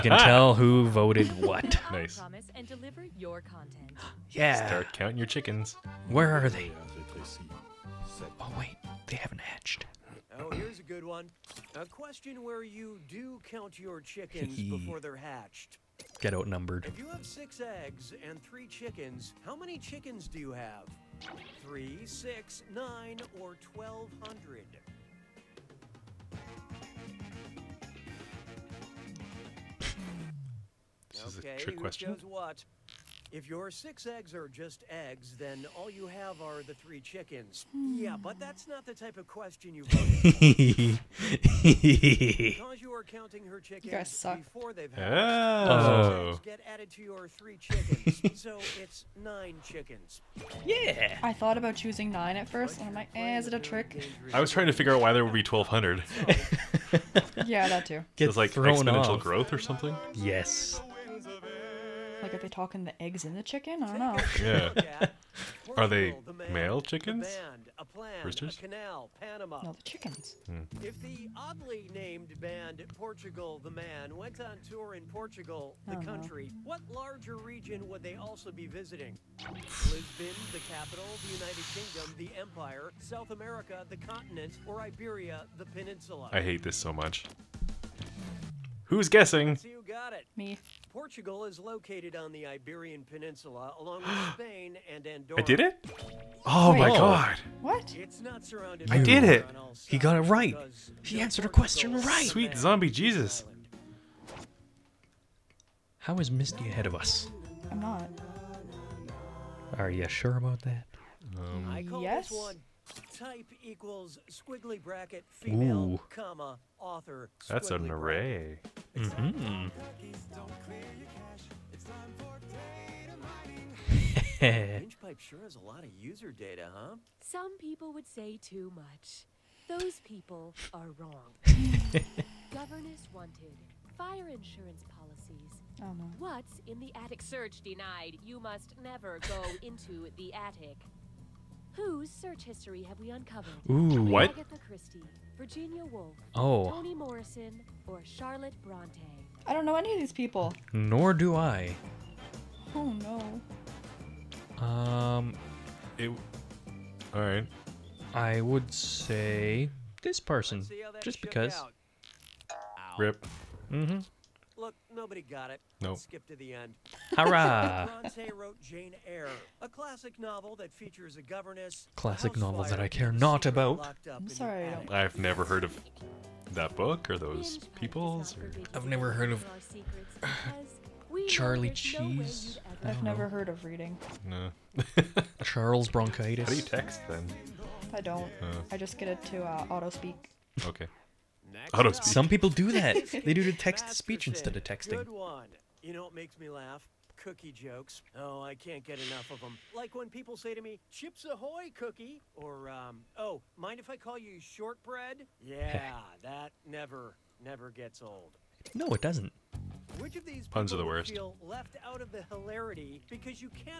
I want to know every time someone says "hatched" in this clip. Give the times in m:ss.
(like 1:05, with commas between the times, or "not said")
0:09, 0:15.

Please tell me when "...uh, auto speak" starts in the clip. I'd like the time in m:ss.
3:09.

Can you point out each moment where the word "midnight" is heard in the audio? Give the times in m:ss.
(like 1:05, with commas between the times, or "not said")
not said.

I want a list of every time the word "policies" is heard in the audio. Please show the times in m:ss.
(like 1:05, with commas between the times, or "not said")
2:14.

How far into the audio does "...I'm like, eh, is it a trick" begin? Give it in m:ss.
0:52.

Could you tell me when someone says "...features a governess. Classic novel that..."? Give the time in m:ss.
2:50.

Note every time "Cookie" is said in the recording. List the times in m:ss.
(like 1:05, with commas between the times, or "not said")
3:17, 3:21.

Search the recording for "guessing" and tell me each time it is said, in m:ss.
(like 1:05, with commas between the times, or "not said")
1:29.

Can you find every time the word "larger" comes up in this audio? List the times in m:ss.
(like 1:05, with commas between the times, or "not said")
1:16.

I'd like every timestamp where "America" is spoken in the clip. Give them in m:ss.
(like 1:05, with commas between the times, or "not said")
1:23.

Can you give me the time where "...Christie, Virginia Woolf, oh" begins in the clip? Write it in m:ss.
2:24.